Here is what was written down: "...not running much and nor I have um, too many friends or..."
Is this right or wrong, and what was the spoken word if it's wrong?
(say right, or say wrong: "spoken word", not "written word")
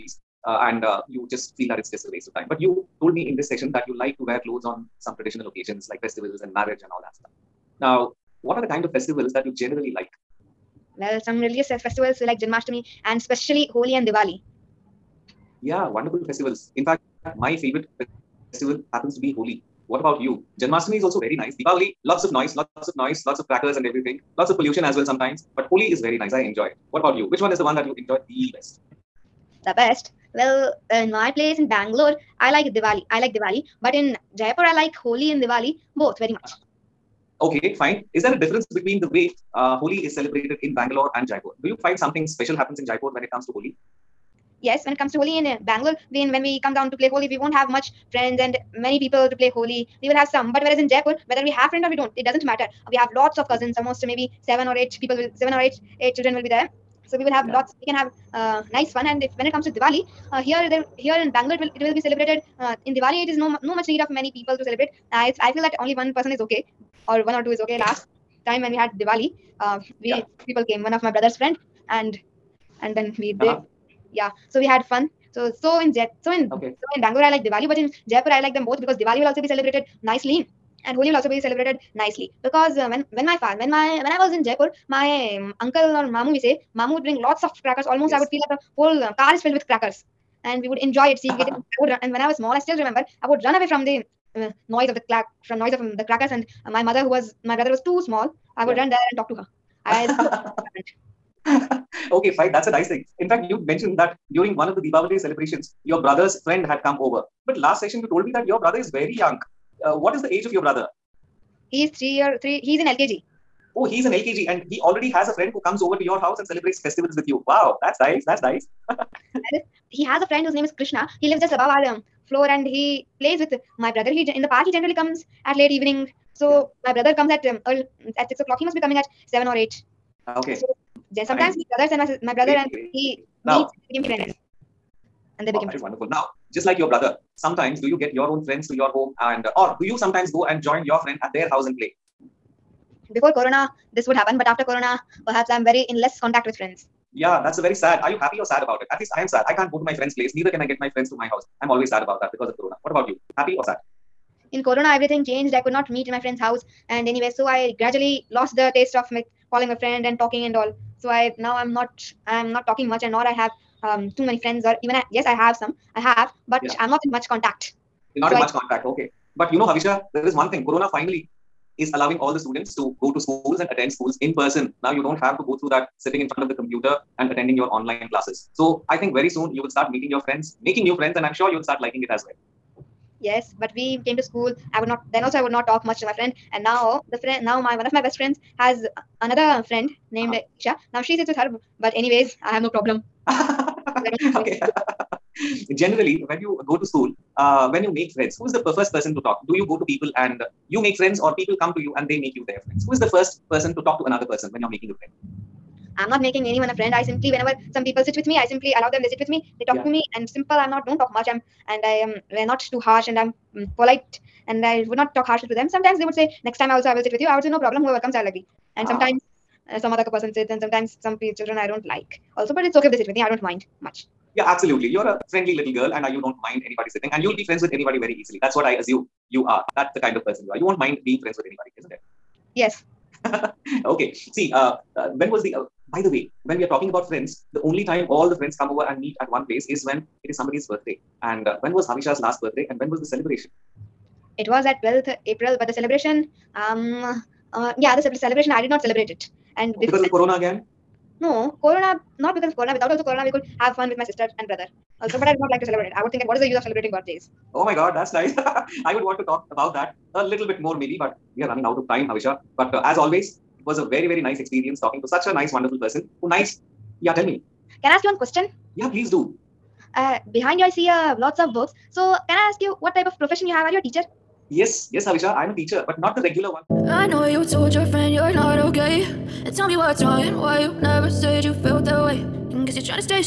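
wrong: "talking", not "running".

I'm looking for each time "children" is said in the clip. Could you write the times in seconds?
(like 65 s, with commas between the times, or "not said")
56 s, 221 s.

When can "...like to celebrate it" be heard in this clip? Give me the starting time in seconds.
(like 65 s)
255 s.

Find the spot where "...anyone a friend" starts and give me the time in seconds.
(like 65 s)
206 s.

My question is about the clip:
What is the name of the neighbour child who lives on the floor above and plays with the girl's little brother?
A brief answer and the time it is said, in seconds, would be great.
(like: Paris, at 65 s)
Krishna, at 120 s.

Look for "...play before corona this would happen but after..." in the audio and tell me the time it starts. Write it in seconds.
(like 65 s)
141 s.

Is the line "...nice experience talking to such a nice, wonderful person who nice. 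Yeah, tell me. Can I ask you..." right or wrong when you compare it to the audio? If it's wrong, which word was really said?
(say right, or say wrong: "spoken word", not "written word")
right.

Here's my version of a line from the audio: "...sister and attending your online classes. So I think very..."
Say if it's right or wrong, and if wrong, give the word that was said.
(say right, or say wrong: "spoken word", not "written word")
wrong: "computer", not "sister".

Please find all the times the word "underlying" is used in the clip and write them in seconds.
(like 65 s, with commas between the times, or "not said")
not said.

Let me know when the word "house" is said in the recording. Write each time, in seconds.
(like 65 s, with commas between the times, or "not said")
116 s, 141 s, 151 s, 156 s.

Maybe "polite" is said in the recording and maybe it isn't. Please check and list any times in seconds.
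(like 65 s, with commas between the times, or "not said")
213 s.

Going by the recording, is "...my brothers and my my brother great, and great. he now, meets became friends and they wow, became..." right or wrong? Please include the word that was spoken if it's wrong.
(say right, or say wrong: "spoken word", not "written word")
right.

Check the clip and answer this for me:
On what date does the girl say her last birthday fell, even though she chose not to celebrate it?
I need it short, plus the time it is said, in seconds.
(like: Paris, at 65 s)
12th April, at 244 s.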